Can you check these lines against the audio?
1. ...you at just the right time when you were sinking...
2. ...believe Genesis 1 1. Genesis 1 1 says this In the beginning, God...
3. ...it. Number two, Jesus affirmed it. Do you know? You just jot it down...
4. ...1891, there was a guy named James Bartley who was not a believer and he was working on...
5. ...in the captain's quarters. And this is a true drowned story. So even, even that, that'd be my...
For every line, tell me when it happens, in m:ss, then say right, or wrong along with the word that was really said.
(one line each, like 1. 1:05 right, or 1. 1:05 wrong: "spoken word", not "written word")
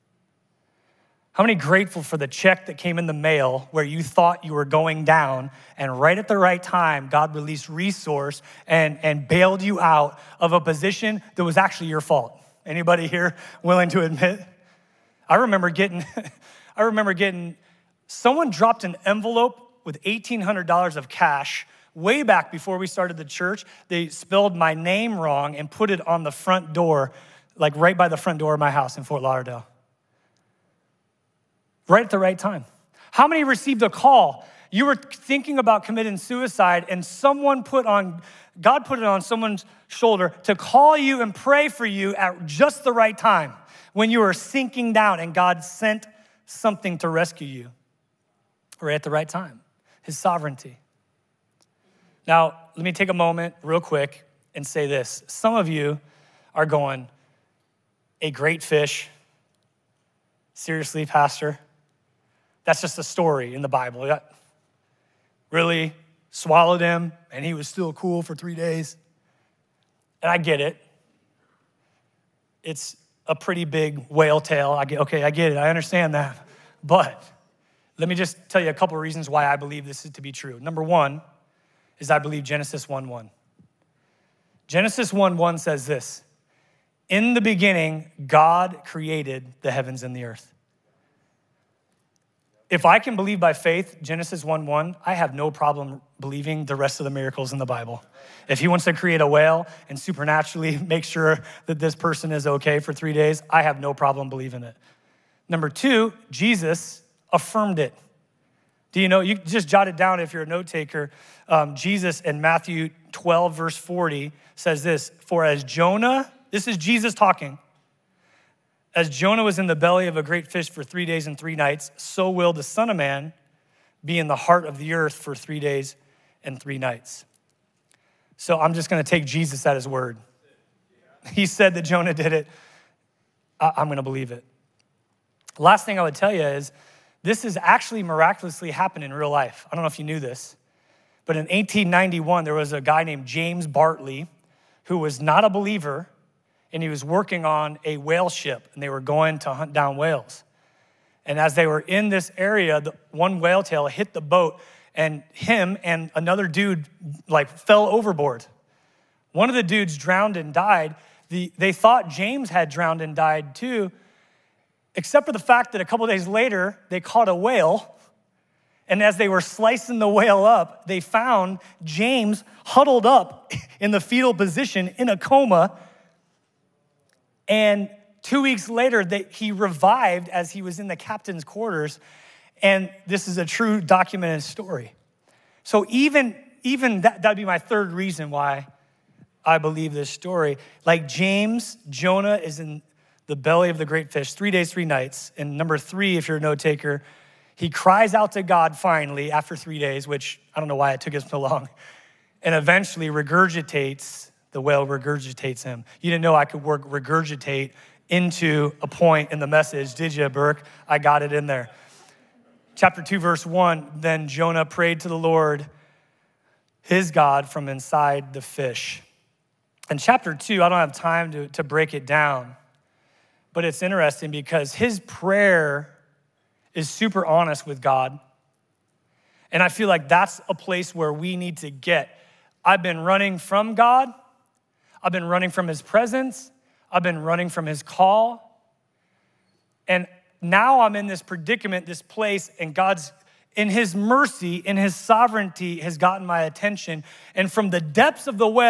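1. 0:41 right
2. 1:22 right
3. 1:44 right
4. 2:21 right
5. 3:00 wrong: "documented", not "drowned".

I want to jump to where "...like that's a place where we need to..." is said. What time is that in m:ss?
3:49.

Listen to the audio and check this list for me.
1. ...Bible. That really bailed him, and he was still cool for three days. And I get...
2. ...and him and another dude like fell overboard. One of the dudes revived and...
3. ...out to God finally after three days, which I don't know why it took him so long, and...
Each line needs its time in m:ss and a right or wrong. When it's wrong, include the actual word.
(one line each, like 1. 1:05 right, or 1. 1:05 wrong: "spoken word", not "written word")
1. 1:03 wrong: "swallowed", not "bailed"
2. 2:34 wrong: "drowned", not "revived"
3. 3:18 right.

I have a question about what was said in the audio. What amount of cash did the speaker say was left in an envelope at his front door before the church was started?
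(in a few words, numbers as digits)
$1,800.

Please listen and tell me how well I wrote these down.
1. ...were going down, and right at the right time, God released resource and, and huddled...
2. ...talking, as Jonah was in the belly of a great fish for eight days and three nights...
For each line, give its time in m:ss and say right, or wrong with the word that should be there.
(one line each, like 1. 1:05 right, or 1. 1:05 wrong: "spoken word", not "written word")
1. 0:04 wrong: "bailed", not "huddled"
2. 1:57 wrong: "three", not "eight".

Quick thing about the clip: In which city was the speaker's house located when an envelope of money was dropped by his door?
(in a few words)
Fort Lauderdale.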